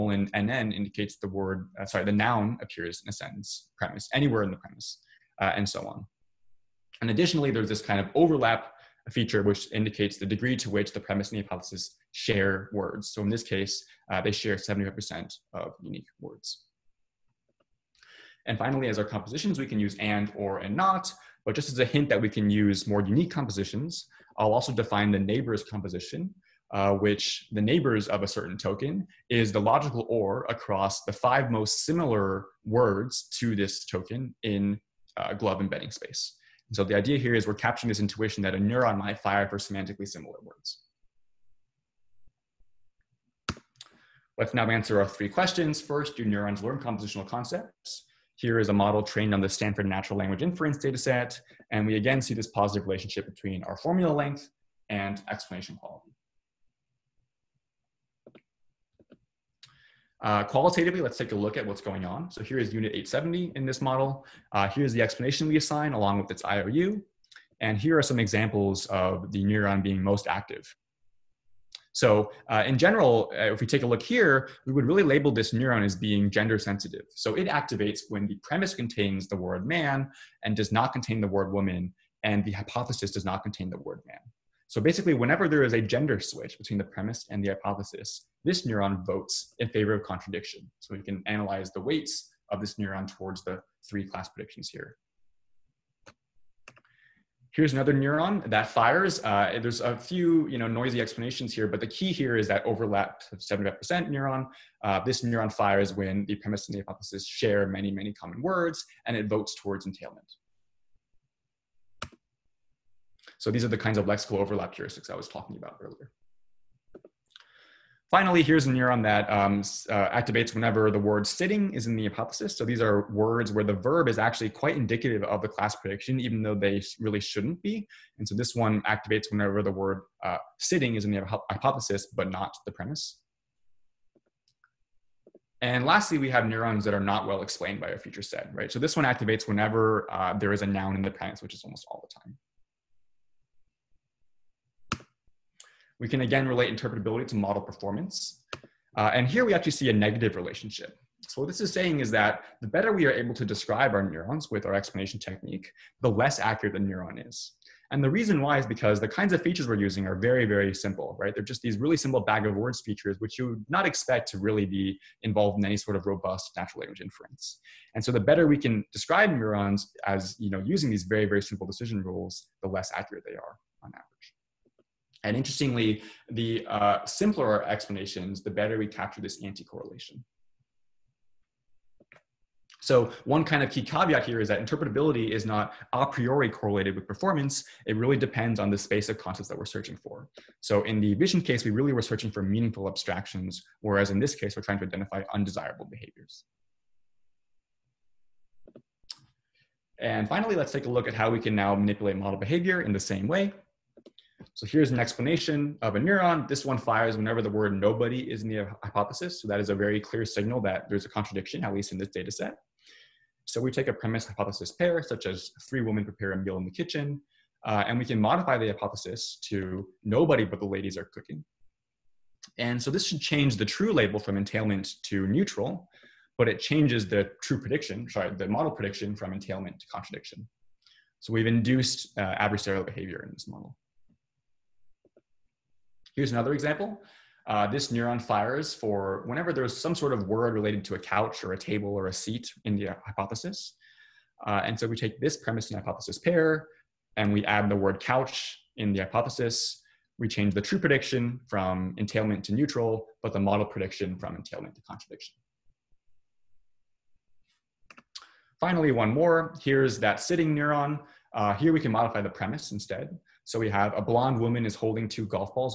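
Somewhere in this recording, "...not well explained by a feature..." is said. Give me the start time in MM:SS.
02:17.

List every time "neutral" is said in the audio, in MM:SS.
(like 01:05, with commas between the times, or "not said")
03:45, 04:12.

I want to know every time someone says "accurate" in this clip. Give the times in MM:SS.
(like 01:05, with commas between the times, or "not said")
02:36, 02:52.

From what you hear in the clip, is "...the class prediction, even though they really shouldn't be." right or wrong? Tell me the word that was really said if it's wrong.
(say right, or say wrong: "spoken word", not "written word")
right.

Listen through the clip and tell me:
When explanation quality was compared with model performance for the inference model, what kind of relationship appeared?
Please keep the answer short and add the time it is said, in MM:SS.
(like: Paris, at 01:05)
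Negative, at 02:29.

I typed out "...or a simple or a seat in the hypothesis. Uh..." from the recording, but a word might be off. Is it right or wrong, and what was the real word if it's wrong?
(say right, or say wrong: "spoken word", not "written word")
wrong: "table", not "simple".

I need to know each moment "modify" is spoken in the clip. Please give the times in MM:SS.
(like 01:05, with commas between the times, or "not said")
03:38, 04:21.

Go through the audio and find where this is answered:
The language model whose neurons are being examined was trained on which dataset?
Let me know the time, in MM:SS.
00:49.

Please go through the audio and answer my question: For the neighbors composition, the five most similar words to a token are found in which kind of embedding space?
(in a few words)
GloVe.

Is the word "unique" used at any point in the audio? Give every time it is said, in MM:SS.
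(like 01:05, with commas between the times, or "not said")
00:15, 00:23.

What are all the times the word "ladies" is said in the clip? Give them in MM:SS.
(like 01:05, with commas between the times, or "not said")
03:40.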